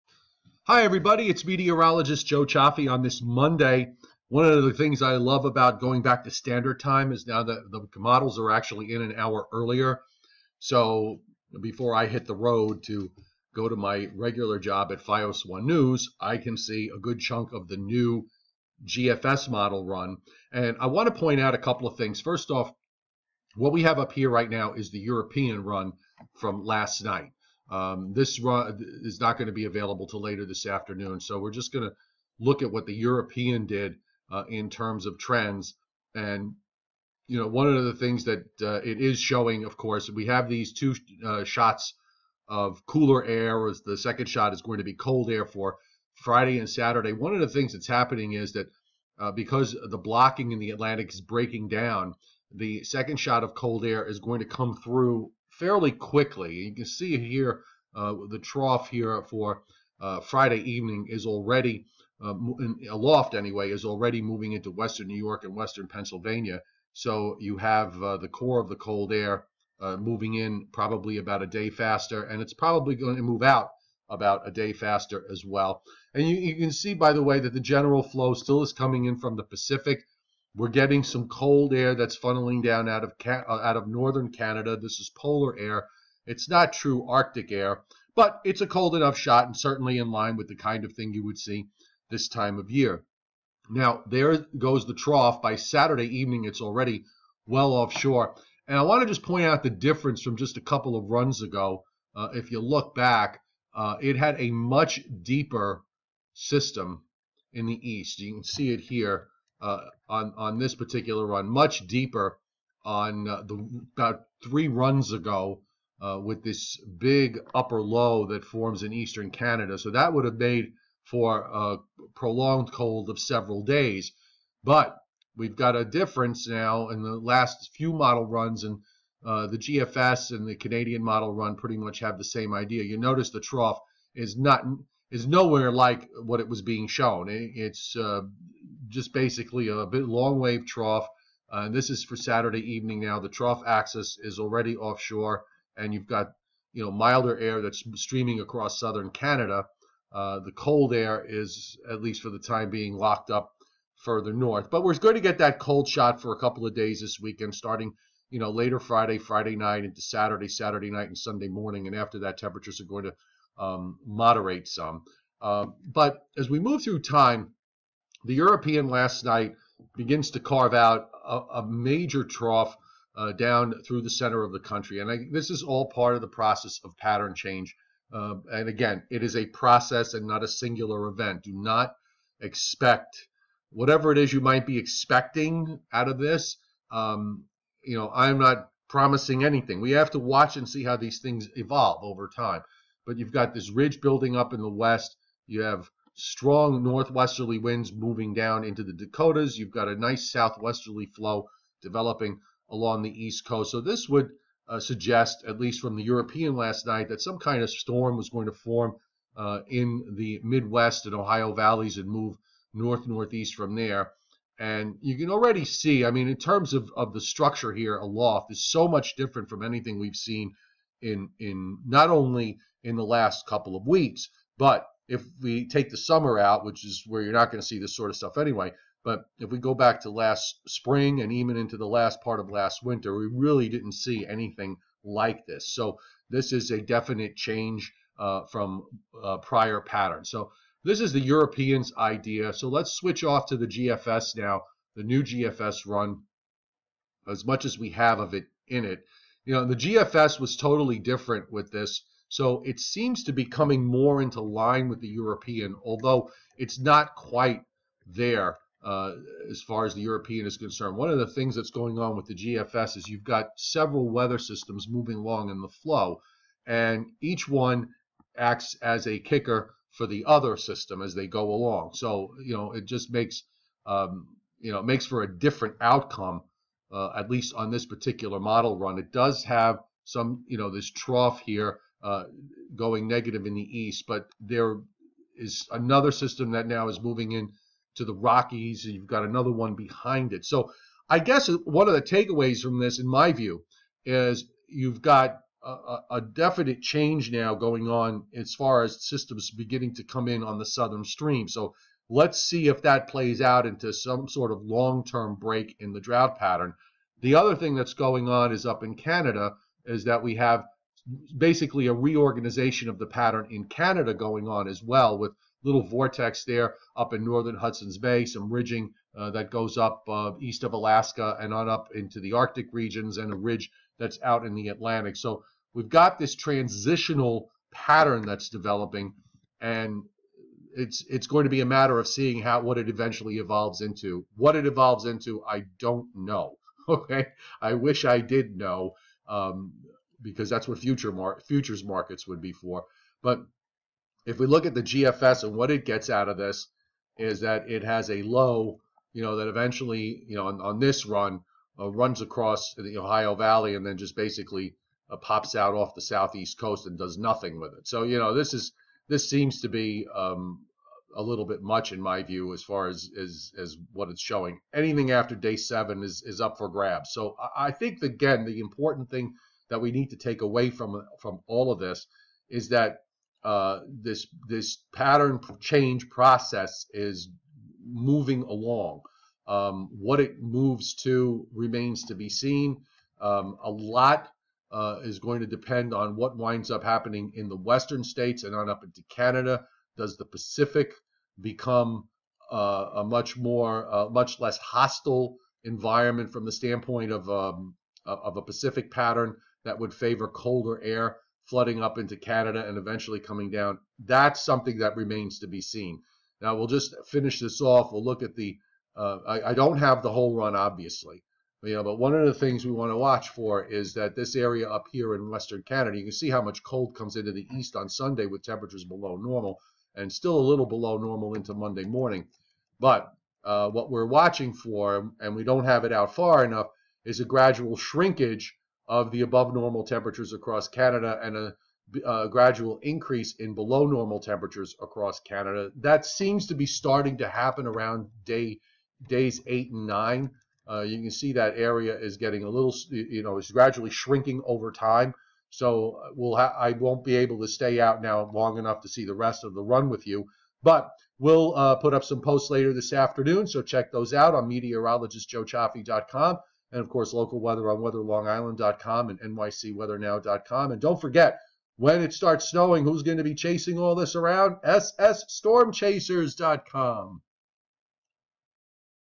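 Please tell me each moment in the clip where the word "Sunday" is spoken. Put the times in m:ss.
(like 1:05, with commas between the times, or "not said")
2:41, 6:57.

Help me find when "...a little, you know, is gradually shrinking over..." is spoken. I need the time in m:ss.
7:22.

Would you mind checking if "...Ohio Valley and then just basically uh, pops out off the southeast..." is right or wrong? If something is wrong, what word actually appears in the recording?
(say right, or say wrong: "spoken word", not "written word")
right.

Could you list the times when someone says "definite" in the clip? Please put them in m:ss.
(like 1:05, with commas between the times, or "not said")
3:56, 4:56.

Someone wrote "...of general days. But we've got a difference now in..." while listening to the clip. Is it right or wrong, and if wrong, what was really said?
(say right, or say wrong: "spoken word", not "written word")
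wrong: "several", not "general".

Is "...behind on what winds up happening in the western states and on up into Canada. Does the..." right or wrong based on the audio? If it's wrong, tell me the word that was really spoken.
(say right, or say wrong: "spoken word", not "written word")
wrong: "depend", not "behind".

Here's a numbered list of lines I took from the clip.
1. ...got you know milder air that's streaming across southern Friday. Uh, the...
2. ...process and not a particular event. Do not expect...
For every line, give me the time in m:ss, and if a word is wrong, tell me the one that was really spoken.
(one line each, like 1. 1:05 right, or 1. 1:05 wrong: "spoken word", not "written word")
1. 2:26 wrong: "Canada", not "Friday"
2. 2:59 wrong: "singular", not "particular".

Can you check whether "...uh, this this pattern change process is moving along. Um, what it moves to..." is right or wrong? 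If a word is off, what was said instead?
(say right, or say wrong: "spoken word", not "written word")
right.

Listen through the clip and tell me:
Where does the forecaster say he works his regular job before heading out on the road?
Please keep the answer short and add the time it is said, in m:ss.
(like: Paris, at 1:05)
FiOS One News, at 0:15.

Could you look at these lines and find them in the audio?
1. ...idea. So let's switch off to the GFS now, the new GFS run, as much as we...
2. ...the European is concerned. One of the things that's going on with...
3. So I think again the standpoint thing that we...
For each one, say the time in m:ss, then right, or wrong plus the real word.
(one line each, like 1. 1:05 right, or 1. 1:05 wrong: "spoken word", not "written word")
1. 4:01 right
2. 4:19 right
3. 6:07 wrong: "important", not "standpoint".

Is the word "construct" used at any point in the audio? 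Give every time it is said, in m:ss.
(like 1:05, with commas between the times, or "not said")
not said.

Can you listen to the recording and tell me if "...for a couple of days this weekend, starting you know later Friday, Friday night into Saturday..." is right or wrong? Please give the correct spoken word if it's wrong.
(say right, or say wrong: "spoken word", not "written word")
right.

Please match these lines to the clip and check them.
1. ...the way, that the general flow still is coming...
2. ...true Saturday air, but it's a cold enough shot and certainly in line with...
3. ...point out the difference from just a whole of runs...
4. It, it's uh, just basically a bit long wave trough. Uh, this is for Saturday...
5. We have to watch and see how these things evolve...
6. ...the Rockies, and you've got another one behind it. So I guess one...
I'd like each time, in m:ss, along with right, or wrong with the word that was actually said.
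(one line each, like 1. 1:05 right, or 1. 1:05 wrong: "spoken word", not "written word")
1. 1:17 right
2. 1:26 wrong: "Arctic", not "Saturday"
3. 1:39 wrong: "couple", not "whole"
4. 2:17 right
5. 3:09 right
6. 4:48 right.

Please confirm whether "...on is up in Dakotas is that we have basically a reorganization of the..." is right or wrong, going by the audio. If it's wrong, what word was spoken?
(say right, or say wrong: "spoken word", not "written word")
wrong: "Canada", not "Dakotas".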